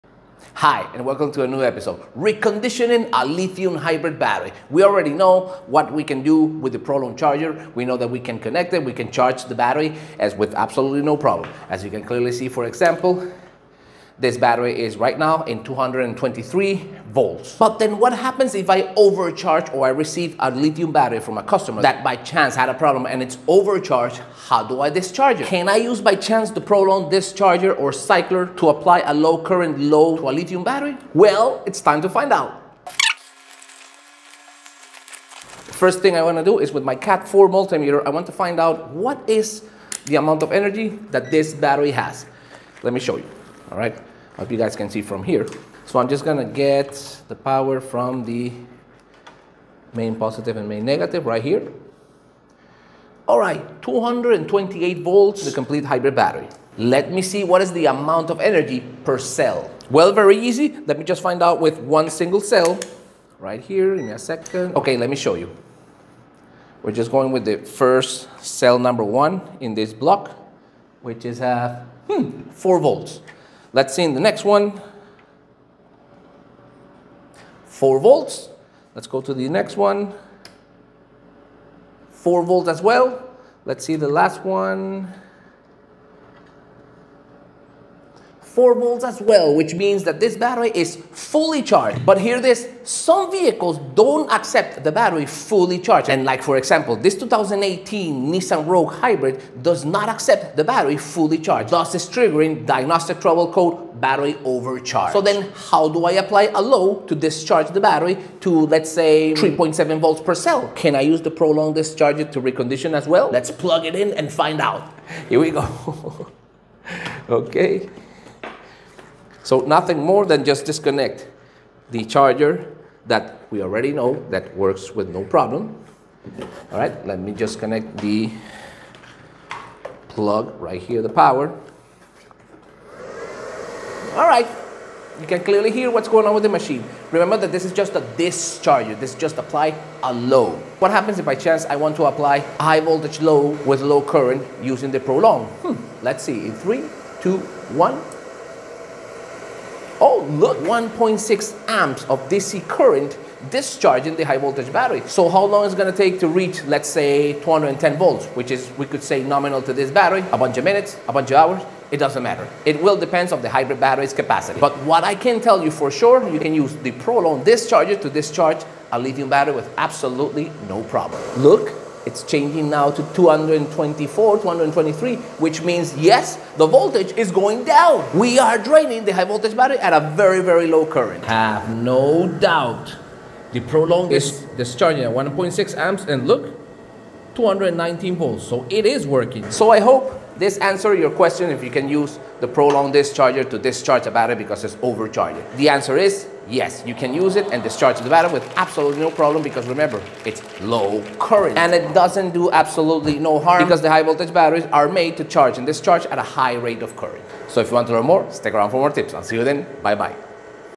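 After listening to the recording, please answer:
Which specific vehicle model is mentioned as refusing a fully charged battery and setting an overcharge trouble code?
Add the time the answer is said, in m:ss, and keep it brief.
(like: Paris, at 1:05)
2018 Nissan Rogue Hybrid, at 1:37.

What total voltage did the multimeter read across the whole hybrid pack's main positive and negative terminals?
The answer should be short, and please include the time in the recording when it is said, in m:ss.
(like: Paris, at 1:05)
228 volts, at 0:53.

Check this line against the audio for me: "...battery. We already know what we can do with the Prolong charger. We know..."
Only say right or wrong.
right.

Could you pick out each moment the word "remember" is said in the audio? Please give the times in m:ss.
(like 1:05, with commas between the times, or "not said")
2:17, 3:19.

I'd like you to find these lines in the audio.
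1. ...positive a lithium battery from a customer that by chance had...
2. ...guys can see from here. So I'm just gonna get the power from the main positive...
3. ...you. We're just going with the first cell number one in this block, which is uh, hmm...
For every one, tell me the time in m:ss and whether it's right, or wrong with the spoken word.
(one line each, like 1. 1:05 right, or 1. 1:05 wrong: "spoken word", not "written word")
1. 0:19 wrong: "receive", not "positive"
2. 0:44 right
3. 1:05 right.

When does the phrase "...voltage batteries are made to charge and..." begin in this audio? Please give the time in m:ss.
3:24.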